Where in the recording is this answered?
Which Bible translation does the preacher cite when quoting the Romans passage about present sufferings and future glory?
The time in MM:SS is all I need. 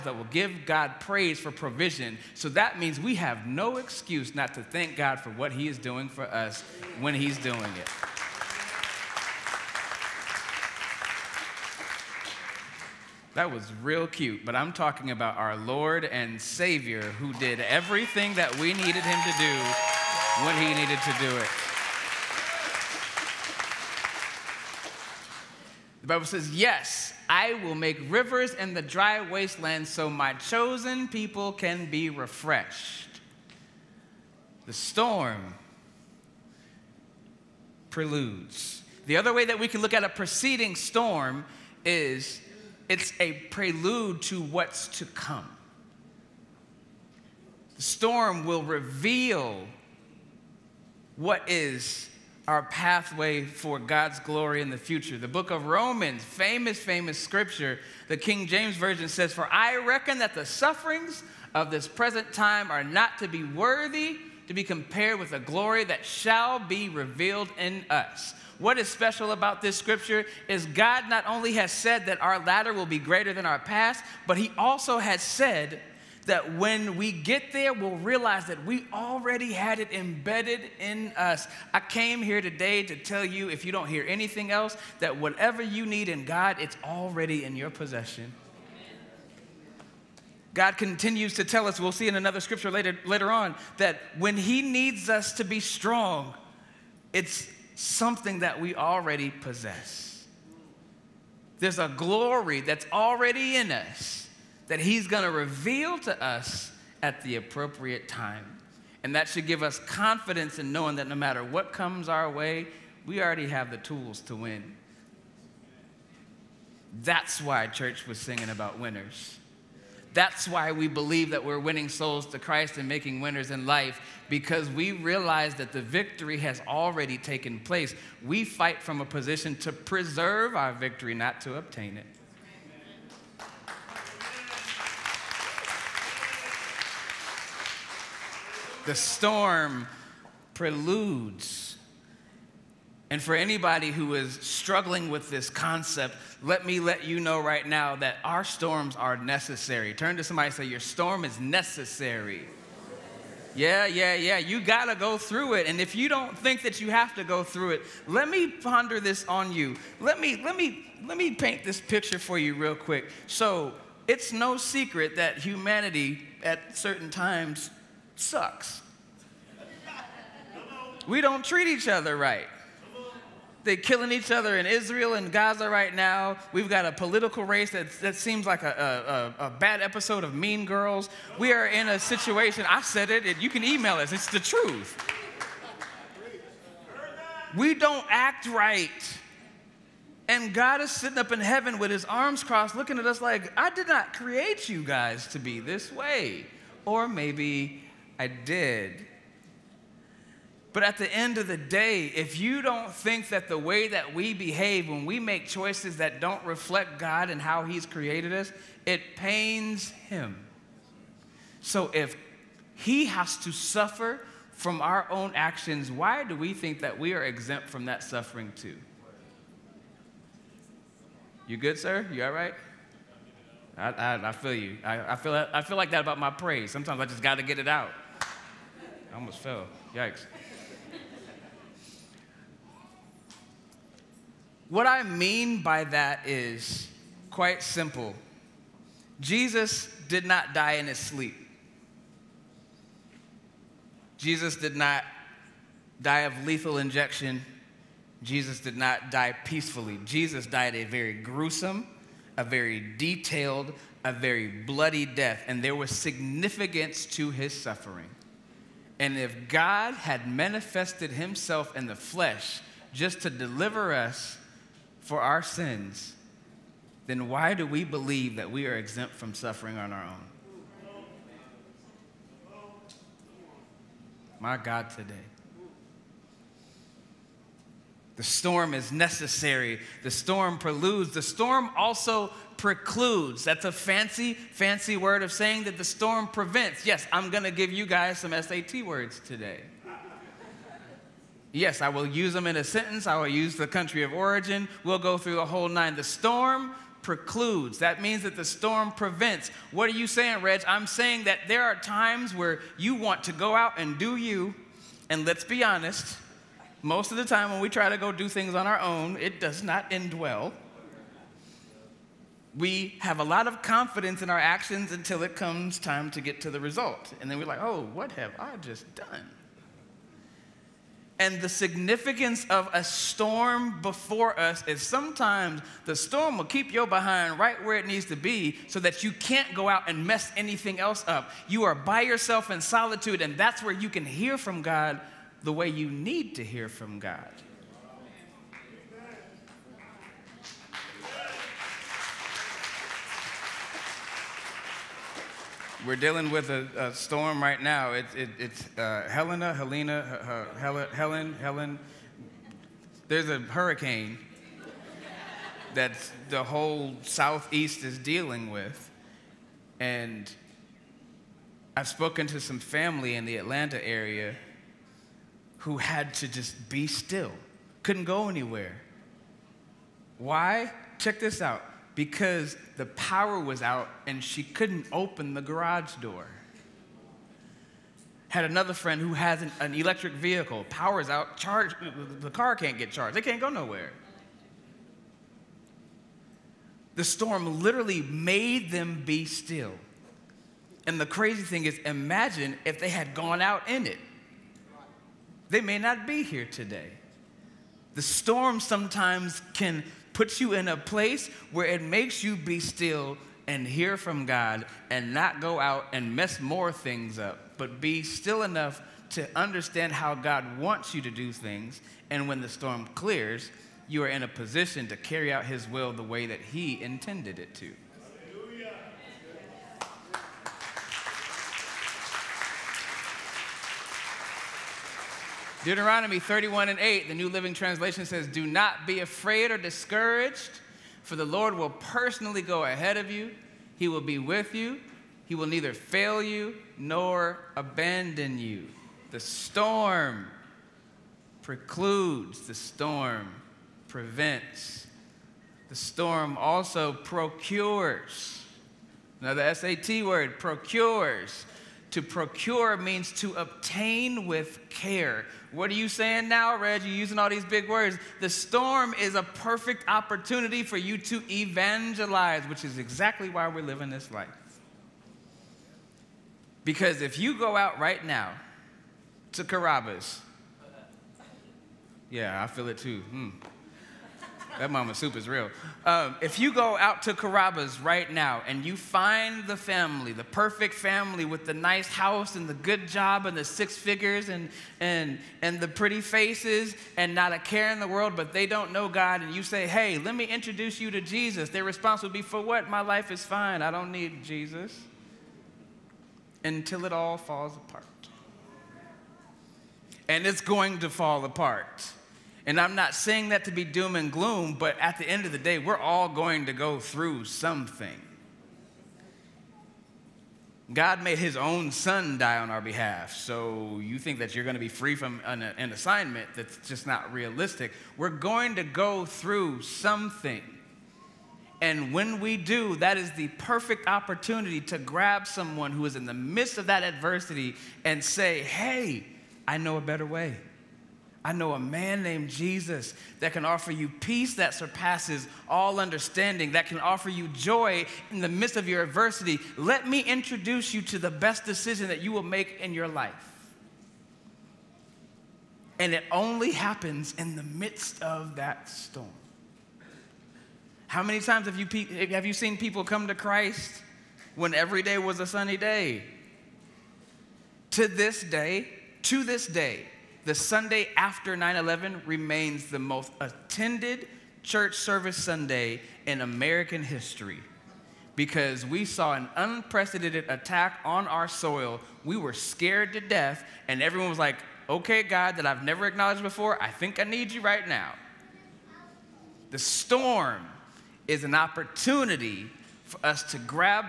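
00:58.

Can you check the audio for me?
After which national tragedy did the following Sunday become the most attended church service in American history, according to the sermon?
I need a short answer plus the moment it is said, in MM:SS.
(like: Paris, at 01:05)
9/11, at 09:21.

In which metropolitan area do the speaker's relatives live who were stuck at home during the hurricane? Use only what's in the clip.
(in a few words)
Atlanta.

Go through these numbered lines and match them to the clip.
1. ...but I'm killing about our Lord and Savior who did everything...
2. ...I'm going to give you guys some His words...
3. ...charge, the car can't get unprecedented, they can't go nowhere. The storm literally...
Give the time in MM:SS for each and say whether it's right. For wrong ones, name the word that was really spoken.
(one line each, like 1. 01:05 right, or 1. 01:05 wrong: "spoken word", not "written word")
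1. 00:14 wrong: "talking", not "killing"
2. 04:47 wrong: "SAT", not "His"
3. 06:21 wrong: "charged", not "unprecedented".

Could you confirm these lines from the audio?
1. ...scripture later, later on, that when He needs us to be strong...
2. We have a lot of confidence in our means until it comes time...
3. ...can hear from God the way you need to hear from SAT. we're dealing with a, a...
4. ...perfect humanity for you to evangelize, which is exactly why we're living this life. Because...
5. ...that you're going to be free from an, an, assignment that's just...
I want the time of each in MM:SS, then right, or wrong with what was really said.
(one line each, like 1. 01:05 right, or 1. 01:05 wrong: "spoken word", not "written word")
1. 01:32 right
2. 05:12 wrong: "actions", not "means"
3. 05:33 wrong: "God", not "SAT"
4. 07:39 wrong: "opportunity", not "humanity"
5. 08:34 right.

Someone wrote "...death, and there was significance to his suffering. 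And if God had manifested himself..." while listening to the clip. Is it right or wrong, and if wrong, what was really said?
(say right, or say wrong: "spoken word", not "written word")
right.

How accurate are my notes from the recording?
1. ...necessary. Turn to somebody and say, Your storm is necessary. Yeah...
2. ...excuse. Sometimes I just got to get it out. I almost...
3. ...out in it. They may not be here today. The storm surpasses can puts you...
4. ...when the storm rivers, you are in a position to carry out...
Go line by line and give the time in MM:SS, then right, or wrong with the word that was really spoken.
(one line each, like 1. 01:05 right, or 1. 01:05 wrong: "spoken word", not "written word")
1. 02:29 right
2. 03:46 wrong: "praise", not "excuse"
3. 06:33 wrong: "sometimes", not "surpasses"
4. 06:52 wrong: "clears", not "rivers".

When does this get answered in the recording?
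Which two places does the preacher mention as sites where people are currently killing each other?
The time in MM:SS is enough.
02:54.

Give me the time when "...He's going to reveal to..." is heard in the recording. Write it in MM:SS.
01:44.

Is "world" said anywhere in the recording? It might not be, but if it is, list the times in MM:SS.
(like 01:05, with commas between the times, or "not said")
08:07.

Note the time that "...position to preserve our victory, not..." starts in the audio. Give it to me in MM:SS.
02:09.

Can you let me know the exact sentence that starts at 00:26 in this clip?
The Bible says, Yes, I will make rivers in the dry wasteland so my chosen people can be refreshed.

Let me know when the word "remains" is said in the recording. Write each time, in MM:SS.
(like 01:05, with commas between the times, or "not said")
09:22.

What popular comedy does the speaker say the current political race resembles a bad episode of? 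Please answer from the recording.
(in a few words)
Mean Girls.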